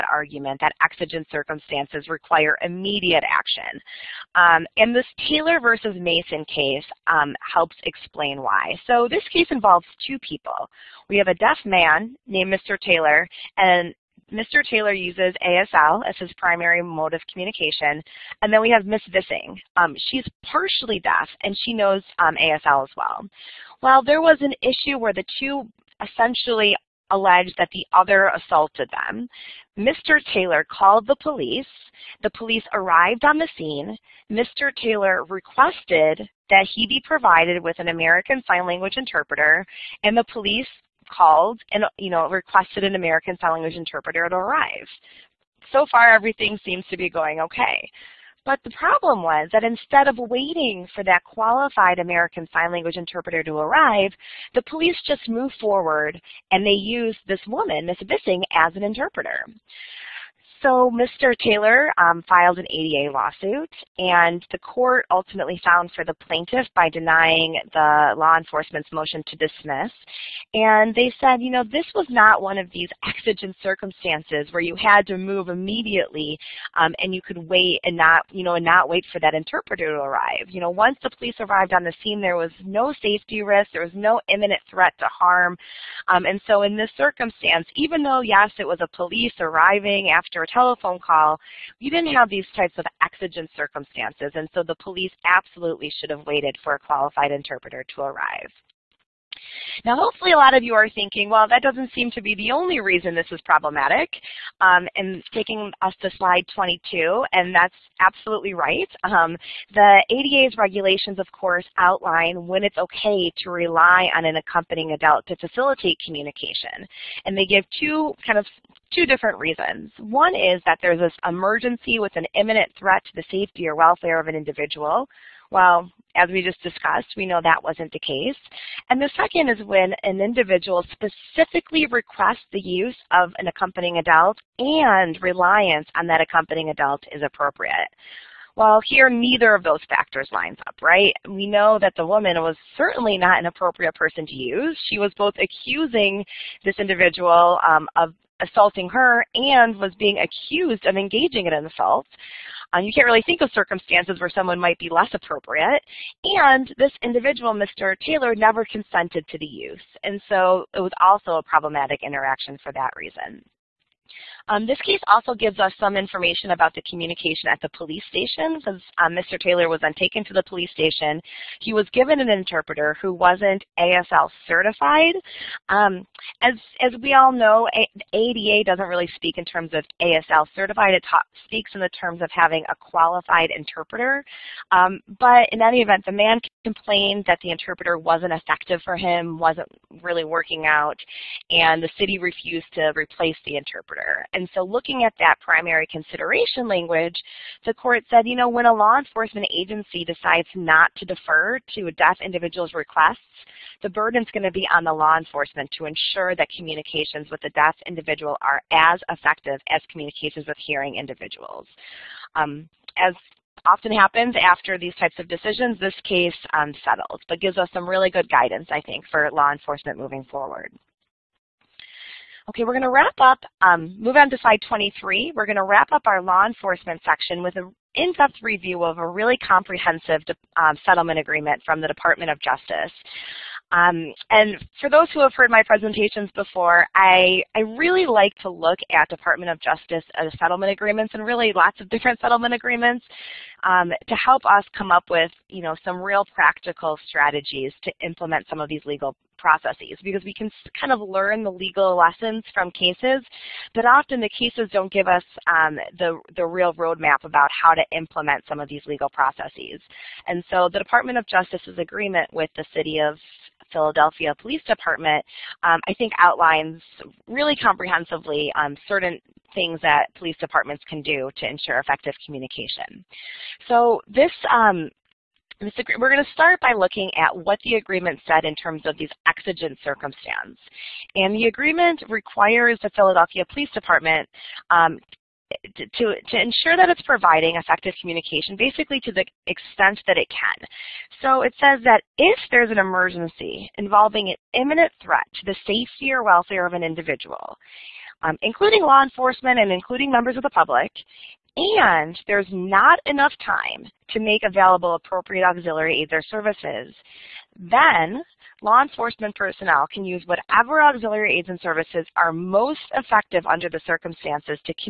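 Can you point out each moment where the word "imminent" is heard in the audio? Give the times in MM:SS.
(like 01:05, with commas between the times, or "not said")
01:24, 02:02, 04:54.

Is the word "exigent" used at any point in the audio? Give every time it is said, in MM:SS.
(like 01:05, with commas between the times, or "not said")
00:00, 01:13, 01:33, 04:39.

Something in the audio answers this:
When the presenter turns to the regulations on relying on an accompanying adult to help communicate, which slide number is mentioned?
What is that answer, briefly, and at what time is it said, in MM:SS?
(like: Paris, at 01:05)
22, at 01:46.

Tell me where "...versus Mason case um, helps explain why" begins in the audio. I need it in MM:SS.
00:05.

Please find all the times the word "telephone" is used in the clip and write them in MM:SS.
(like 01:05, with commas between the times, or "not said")
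01:30.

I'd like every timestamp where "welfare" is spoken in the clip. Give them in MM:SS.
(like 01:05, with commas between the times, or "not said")
02:03, 04:56.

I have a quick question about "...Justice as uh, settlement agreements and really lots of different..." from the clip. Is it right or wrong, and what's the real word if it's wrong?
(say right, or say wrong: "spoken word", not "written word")
right.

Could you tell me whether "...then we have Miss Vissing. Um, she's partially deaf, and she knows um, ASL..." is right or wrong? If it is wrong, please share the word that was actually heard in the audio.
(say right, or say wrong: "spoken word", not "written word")
right.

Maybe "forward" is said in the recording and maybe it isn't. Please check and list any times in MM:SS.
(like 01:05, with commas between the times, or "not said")
00:55, 03:40.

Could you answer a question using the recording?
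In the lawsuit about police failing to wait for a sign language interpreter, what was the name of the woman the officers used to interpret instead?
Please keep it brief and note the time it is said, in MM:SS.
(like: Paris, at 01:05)
Miss Bissing, at 00:57.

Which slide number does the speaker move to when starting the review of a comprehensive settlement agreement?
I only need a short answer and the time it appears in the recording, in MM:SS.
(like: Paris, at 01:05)
23, at 03:44.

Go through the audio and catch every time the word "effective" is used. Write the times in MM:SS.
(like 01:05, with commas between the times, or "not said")
03:08, 03:29, 04:31, 04:47, 05:12.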